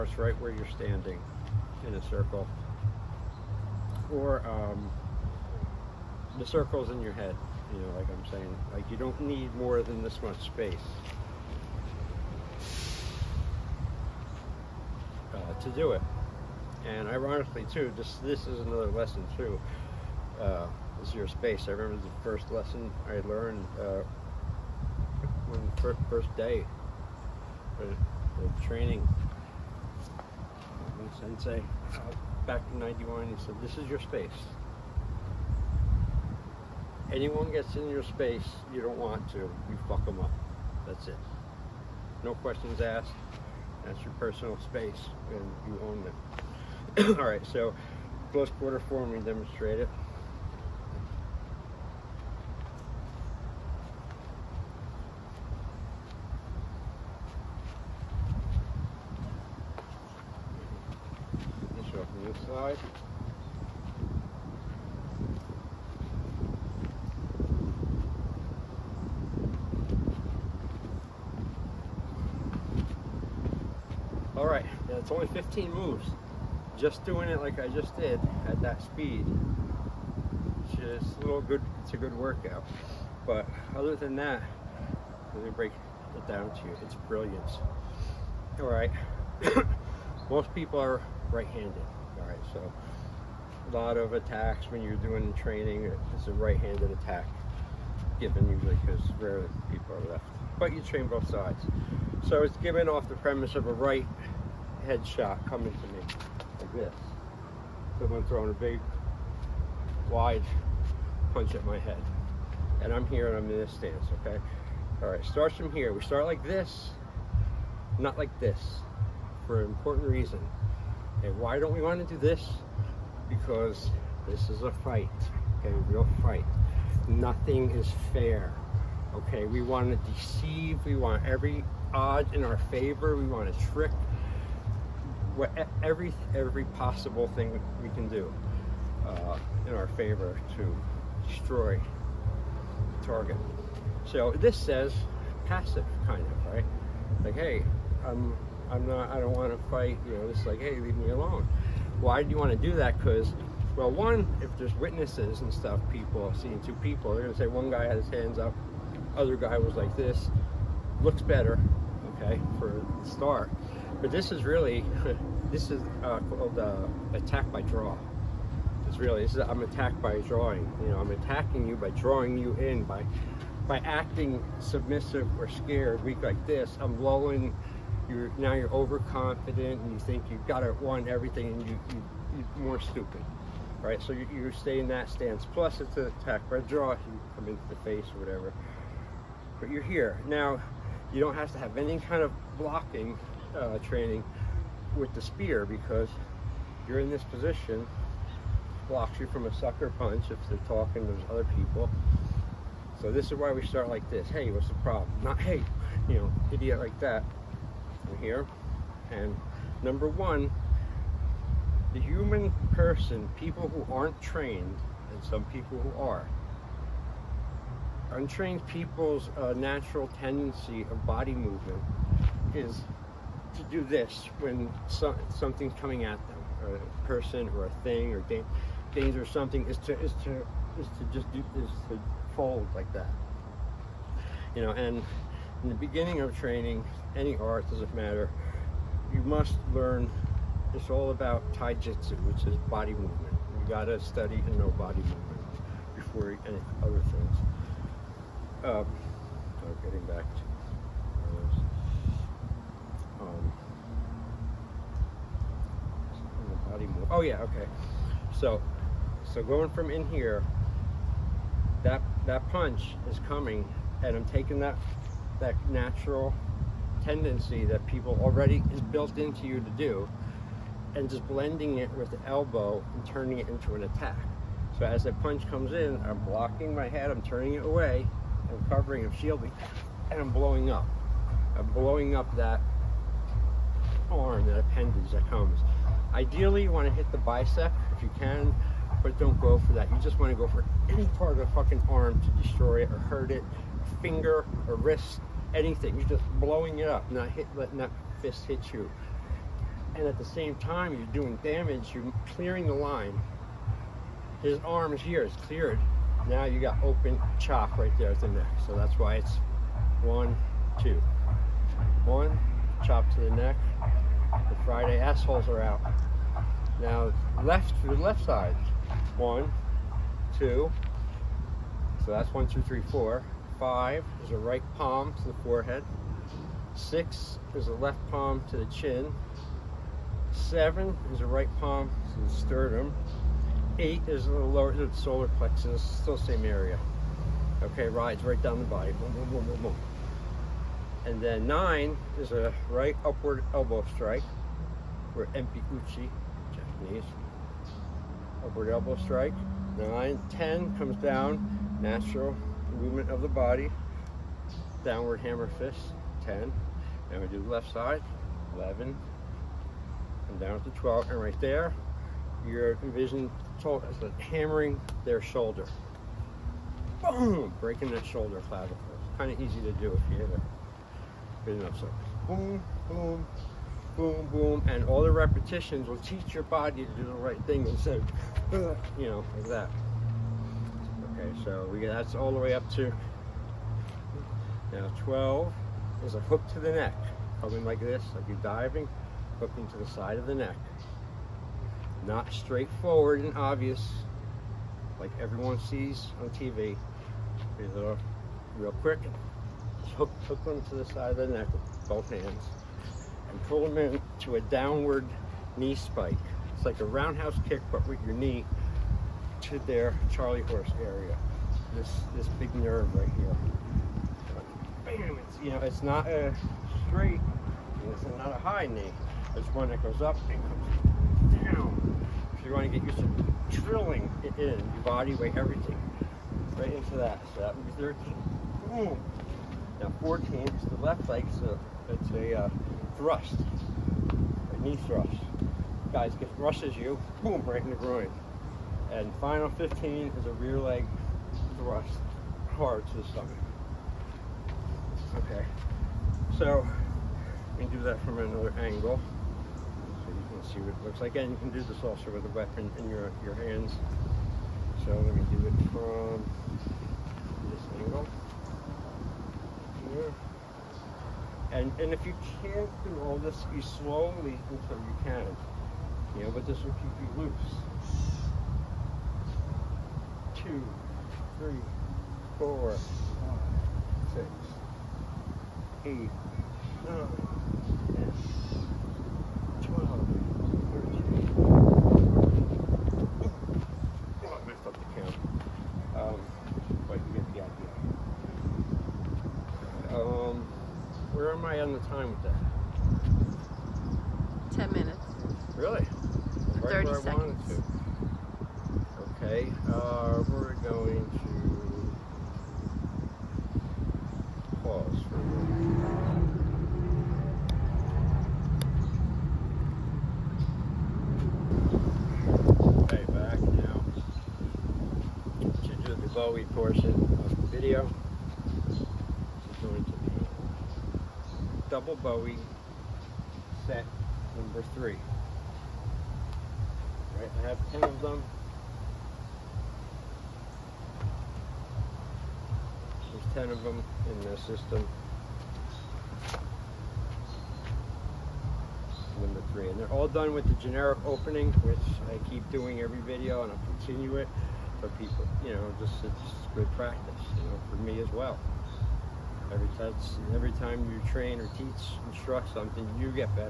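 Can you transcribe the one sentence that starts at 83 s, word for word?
But other than that, let me break it down to you.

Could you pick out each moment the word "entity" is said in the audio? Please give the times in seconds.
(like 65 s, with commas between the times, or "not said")
not said.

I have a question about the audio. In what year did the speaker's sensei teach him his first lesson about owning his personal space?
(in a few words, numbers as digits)
1991.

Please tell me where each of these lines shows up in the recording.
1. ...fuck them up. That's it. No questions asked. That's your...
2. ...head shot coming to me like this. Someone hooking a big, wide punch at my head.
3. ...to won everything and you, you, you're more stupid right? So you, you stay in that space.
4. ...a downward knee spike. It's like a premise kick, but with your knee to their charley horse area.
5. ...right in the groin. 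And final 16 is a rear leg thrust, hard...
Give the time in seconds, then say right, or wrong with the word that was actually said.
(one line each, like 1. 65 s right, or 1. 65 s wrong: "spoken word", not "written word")
1. 39 s right
2. 104 s wrong: "throwing", not "hooking"
3. 180 s wrong: "stance", not "space"
4. 404 s wrong: "roundhouse", not "premise"
5. 437 s wrong: "15", not "16".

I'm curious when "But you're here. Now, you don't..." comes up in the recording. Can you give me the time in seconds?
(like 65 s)
189 s.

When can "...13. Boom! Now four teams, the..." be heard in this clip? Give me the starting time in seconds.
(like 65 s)
427 s.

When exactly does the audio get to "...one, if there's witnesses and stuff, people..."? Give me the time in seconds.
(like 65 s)
153 s.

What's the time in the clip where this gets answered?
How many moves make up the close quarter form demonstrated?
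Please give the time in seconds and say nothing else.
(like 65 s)
75 s.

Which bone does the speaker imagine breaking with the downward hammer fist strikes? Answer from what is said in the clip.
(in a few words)
clavicle.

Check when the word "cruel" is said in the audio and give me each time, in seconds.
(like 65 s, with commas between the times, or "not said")
not said.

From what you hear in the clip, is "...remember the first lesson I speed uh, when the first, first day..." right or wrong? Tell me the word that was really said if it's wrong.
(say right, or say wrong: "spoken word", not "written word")
wrong: "learned", not "speed".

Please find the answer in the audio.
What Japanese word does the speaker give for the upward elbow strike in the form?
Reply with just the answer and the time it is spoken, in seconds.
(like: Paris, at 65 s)
Empi, at 345 s.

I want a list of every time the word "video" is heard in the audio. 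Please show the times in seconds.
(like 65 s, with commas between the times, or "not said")
517 s, 542 s.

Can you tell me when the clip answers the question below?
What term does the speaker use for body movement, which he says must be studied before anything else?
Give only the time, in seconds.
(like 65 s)
241 s.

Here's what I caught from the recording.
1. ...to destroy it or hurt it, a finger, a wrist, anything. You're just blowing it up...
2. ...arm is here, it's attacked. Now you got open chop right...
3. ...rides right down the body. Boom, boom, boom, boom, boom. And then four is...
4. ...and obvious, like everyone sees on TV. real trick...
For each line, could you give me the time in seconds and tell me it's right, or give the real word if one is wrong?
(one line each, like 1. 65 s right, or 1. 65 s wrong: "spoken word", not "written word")
1. 292 s right
2. 304 s wrong: "cleared", not "attacked"
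3. 337 s wrong: "nine", not "four"
4. 393 s wrong: "quick", not "trick".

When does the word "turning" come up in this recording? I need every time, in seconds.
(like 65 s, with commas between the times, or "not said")
273 s, 277 s.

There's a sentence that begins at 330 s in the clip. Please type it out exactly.
Seven is a right palm to the sternum.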